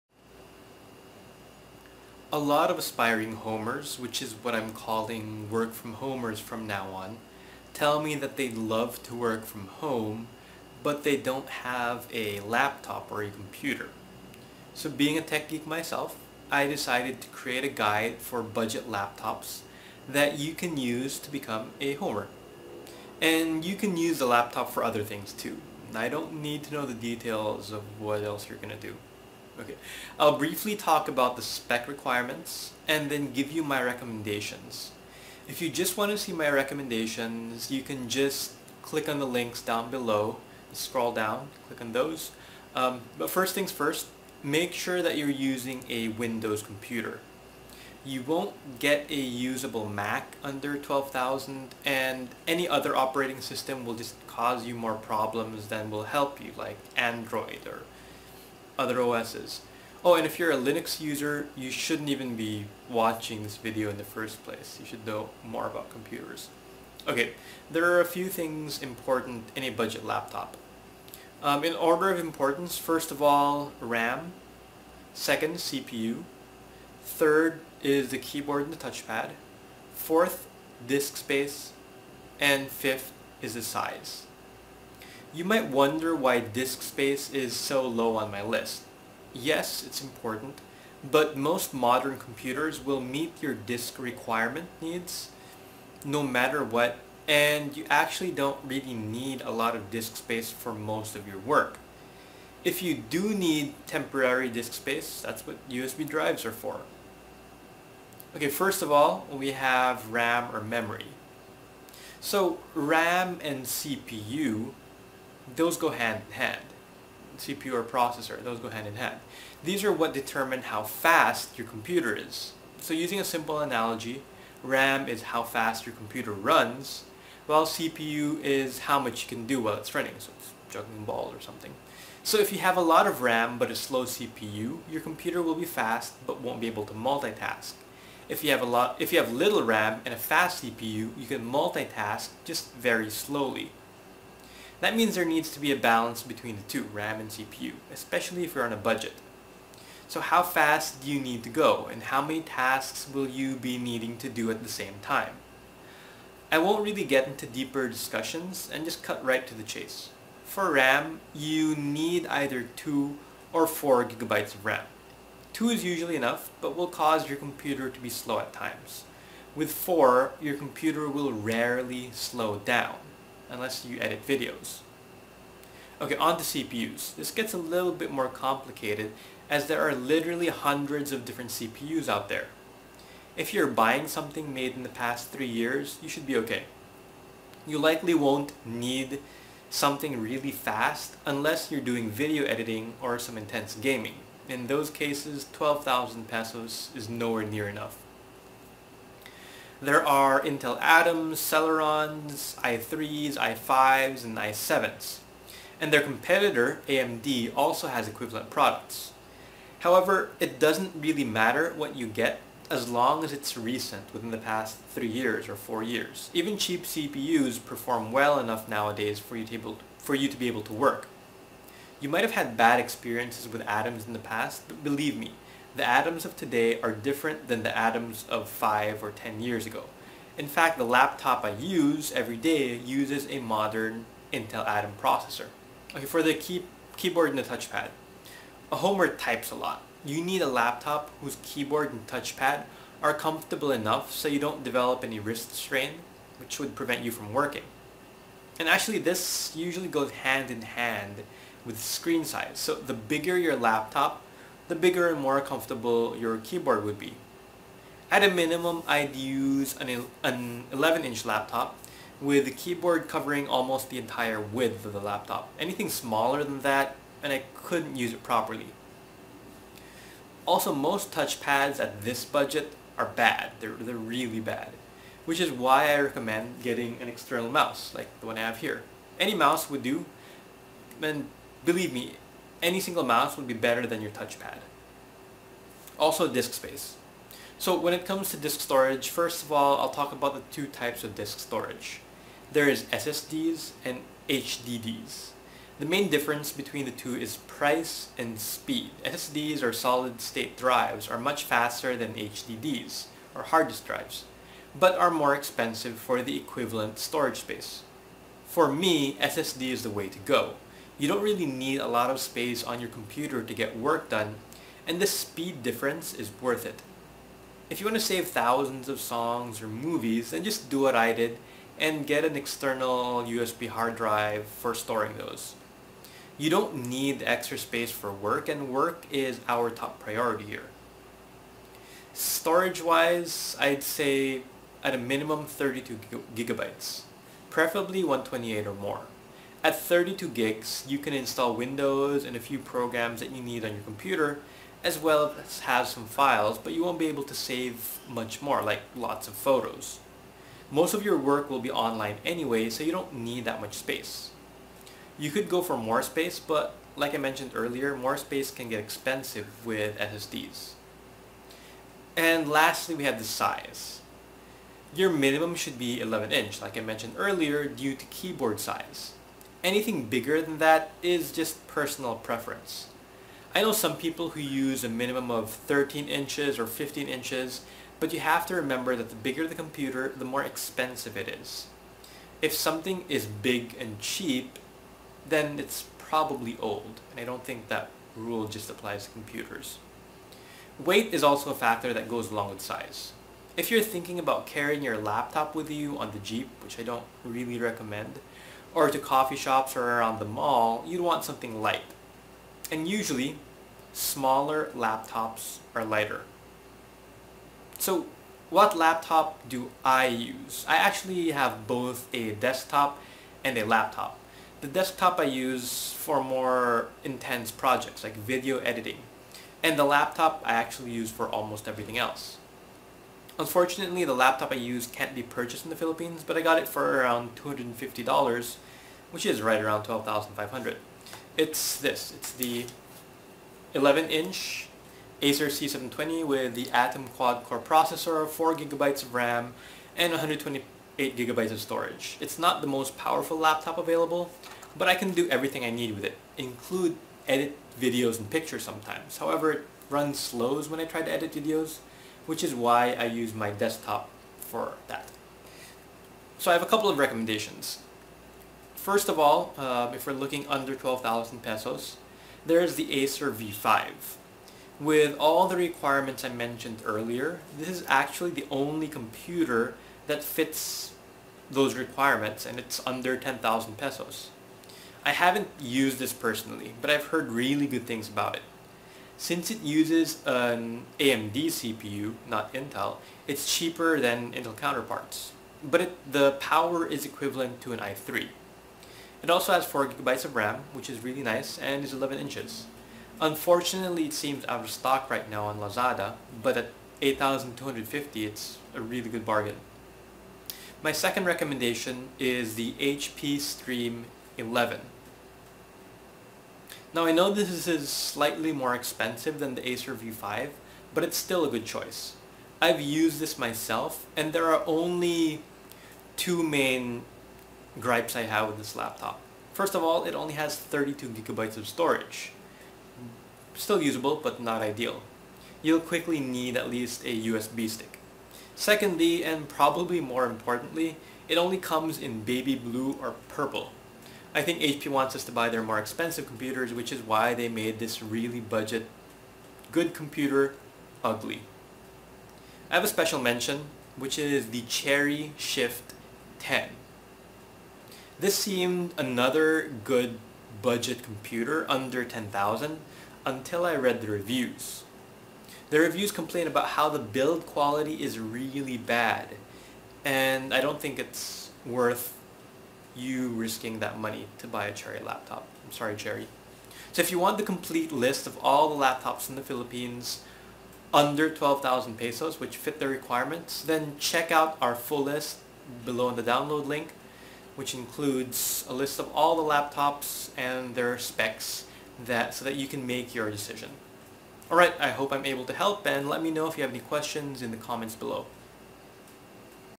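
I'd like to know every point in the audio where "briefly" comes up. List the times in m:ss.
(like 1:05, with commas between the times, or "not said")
0:30.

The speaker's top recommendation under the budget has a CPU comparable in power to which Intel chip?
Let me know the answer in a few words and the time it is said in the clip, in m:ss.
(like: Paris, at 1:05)
i3, at 8:07.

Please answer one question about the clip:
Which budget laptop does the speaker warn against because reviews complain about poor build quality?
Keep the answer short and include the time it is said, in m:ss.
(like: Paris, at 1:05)
Cherry Shift 10, at 9:04.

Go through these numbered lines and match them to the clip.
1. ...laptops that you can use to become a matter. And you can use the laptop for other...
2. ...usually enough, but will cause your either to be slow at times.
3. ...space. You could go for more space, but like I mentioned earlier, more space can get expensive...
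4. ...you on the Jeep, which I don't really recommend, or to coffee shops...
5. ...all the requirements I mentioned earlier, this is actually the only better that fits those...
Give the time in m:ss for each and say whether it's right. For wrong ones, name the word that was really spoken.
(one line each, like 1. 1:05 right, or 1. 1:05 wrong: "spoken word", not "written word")
1. 0:18 wrong: "homer", not "matter"
2. 2:45 wrong: "computer", not "either"
3. 5:53 right
4. 6:35 right
5. 7:45 wrong: "computer", not "better".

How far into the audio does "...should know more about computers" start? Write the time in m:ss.
1:04.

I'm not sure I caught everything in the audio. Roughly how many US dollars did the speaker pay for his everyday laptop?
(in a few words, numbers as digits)
$250.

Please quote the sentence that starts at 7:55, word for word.
I haven't used this personally, but I've heard really good things about it.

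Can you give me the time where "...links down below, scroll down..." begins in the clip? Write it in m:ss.
0:39.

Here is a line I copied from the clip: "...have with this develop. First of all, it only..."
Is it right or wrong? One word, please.
wrong.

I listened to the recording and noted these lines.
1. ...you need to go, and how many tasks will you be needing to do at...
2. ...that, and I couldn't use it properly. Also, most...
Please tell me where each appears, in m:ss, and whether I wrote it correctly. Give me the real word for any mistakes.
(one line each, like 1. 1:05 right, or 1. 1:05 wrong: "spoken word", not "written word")
1. 2:31 right
2. 4:26 right.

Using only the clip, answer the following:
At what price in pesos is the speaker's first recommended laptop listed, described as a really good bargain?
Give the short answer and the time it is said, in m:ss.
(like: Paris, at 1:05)
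8250 pesos, at 8:17.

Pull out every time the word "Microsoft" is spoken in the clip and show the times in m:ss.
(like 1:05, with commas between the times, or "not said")
not said.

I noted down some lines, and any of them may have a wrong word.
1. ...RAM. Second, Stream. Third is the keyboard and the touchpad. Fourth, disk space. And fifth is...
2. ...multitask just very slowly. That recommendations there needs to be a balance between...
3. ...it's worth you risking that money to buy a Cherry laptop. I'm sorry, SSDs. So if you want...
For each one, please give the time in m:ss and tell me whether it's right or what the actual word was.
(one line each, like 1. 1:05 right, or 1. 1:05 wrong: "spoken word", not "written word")
1. 1:13 wrong: "CPU", not "Stream"
2. 2:21 wrong: "means", not "recommendations"
3. 9:20 wrong: "Cherry", not "SSDs".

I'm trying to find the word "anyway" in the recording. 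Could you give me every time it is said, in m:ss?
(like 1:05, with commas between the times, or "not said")
5:52.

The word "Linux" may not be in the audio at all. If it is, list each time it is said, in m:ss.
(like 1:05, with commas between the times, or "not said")
1:00.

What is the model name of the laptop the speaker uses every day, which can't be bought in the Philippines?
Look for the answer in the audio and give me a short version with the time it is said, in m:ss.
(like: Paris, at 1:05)
Acer C720, at 7:15.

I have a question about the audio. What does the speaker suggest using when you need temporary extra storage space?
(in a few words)
USB drives.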